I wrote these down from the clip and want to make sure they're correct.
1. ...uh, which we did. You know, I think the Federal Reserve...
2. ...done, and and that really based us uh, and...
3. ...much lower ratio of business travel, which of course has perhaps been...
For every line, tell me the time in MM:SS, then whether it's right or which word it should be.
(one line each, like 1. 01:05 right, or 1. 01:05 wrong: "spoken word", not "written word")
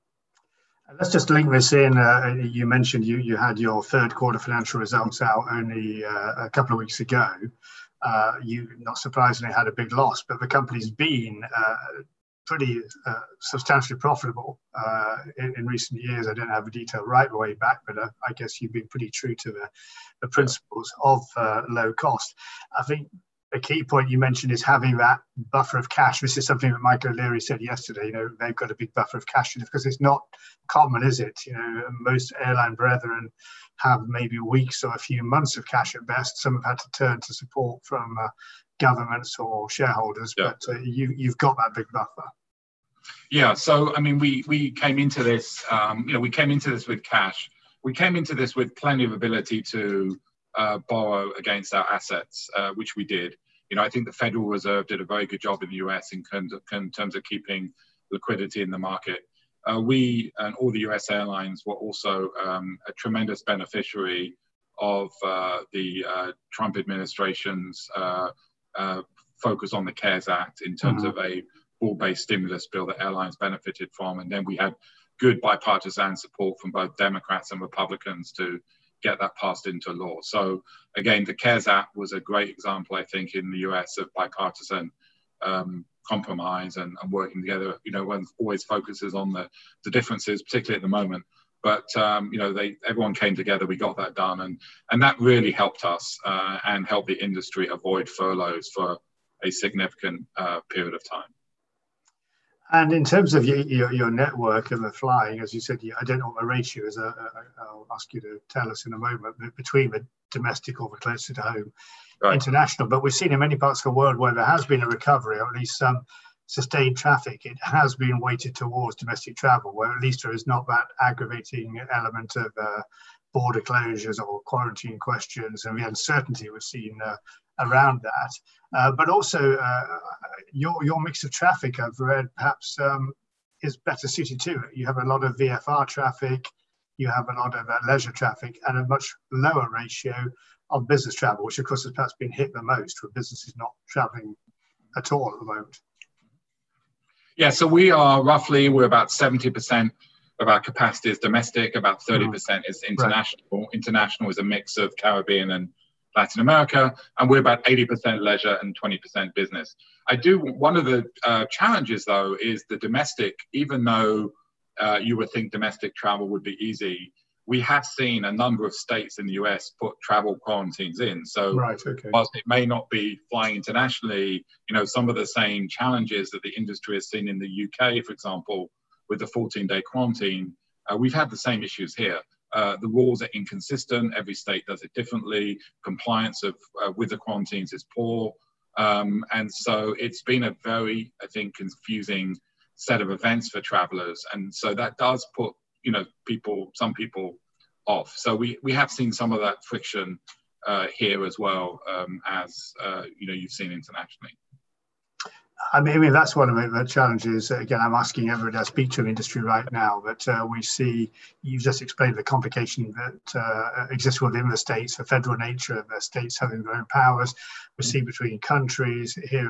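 1. 00:52 right
2. 01:34 wrong: "helped", not "based"
3. 02:18 right.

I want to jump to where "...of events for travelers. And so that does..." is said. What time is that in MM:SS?
03:13.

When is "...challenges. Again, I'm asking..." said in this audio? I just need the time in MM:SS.
03:26.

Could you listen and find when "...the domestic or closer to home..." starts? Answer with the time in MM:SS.
01:49.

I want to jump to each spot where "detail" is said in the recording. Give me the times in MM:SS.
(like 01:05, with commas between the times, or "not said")
00:16.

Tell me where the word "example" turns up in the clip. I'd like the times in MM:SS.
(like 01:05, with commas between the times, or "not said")
01:22, 02:58.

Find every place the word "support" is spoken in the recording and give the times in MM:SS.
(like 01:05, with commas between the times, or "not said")
00:37, 01:16.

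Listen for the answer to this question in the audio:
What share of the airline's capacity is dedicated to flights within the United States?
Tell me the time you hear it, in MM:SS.
02:29.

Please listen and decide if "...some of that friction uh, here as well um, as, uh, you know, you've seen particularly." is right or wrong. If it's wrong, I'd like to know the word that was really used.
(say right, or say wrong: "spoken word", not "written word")
wrong: "internationally", not "particularly".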